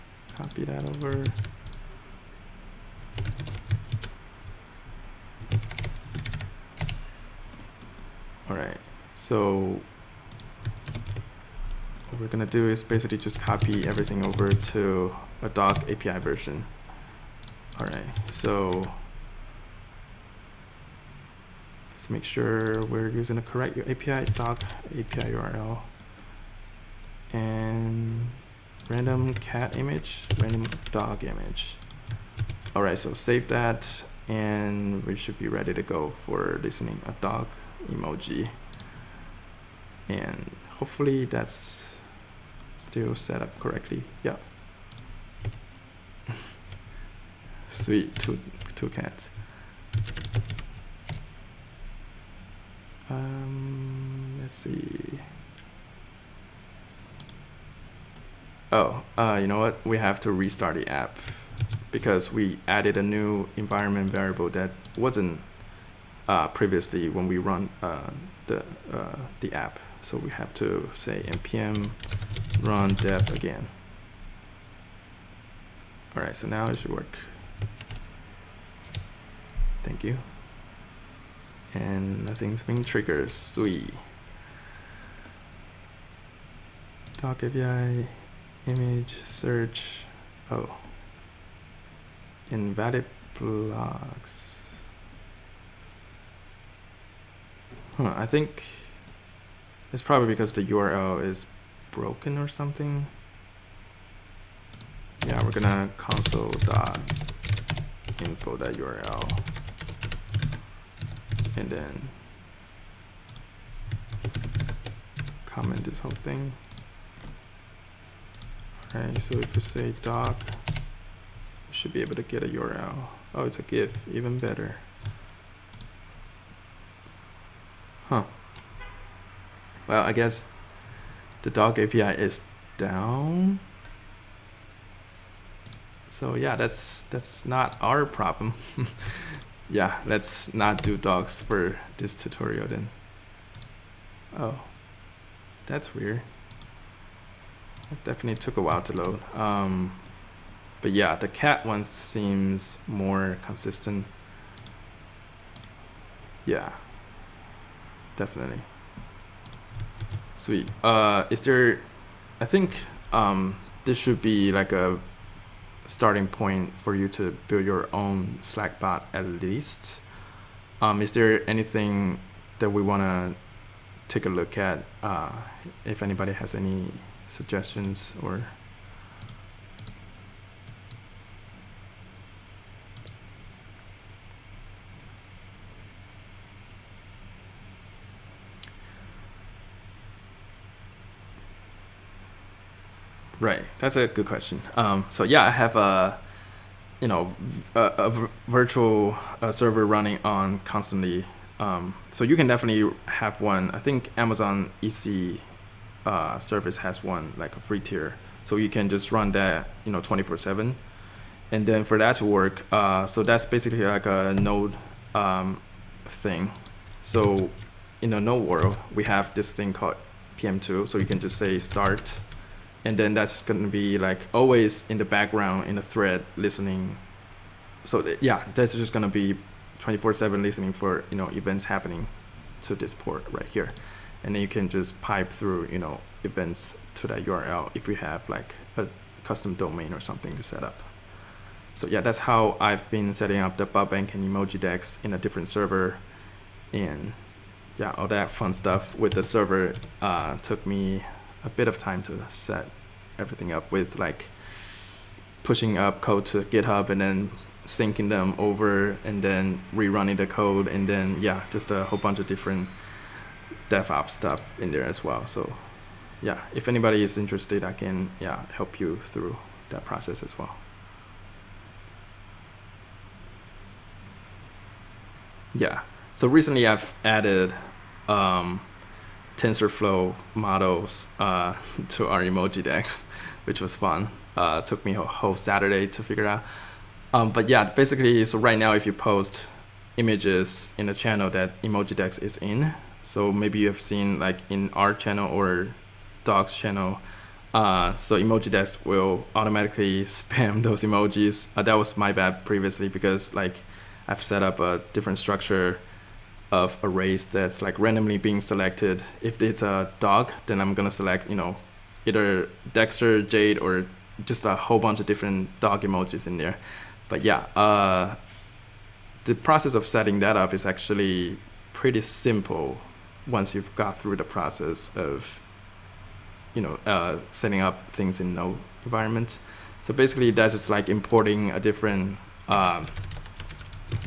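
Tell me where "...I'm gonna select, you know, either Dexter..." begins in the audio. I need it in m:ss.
5:10.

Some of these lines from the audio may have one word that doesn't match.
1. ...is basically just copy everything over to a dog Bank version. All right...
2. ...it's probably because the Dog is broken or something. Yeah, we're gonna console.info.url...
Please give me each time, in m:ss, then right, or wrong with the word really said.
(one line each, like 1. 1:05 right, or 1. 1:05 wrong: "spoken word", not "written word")
1. 0:12 wrong: "API", not "Bank"
2. 1:39 wrong: "URL", not "Dog".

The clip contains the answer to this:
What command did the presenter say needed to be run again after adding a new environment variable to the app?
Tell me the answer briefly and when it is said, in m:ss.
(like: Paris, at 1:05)
npm run dev, at 1:11.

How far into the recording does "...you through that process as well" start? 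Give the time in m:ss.
4:28.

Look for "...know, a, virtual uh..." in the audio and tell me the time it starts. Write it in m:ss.
3:17.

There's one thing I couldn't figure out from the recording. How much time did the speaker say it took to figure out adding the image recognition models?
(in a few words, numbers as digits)
a whole Saturday.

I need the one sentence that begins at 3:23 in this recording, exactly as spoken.
I think Amazon EC uh, service has one like a free tier, so you can just run that you know 24/7.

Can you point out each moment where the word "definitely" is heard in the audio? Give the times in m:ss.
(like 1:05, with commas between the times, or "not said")
2:28, 2:38, 3:22.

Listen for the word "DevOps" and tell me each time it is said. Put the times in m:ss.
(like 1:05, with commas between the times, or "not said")
4:23.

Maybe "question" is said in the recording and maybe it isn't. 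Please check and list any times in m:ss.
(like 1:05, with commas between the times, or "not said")
3:14.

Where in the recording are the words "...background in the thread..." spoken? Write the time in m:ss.
3:45.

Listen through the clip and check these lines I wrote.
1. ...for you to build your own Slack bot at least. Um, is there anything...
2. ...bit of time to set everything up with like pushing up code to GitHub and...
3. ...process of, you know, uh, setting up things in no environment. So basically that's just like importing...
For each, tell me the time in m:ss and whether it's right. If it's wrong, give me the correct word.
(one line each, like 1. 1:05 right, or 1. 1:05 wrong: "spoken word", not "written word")
1. 2:46 right
2. 4:11 right
3. 5:24 right.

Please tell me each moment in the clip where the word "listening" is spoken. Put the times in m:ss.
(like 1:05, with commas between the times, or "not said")
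0:36, 3:46, 3:50.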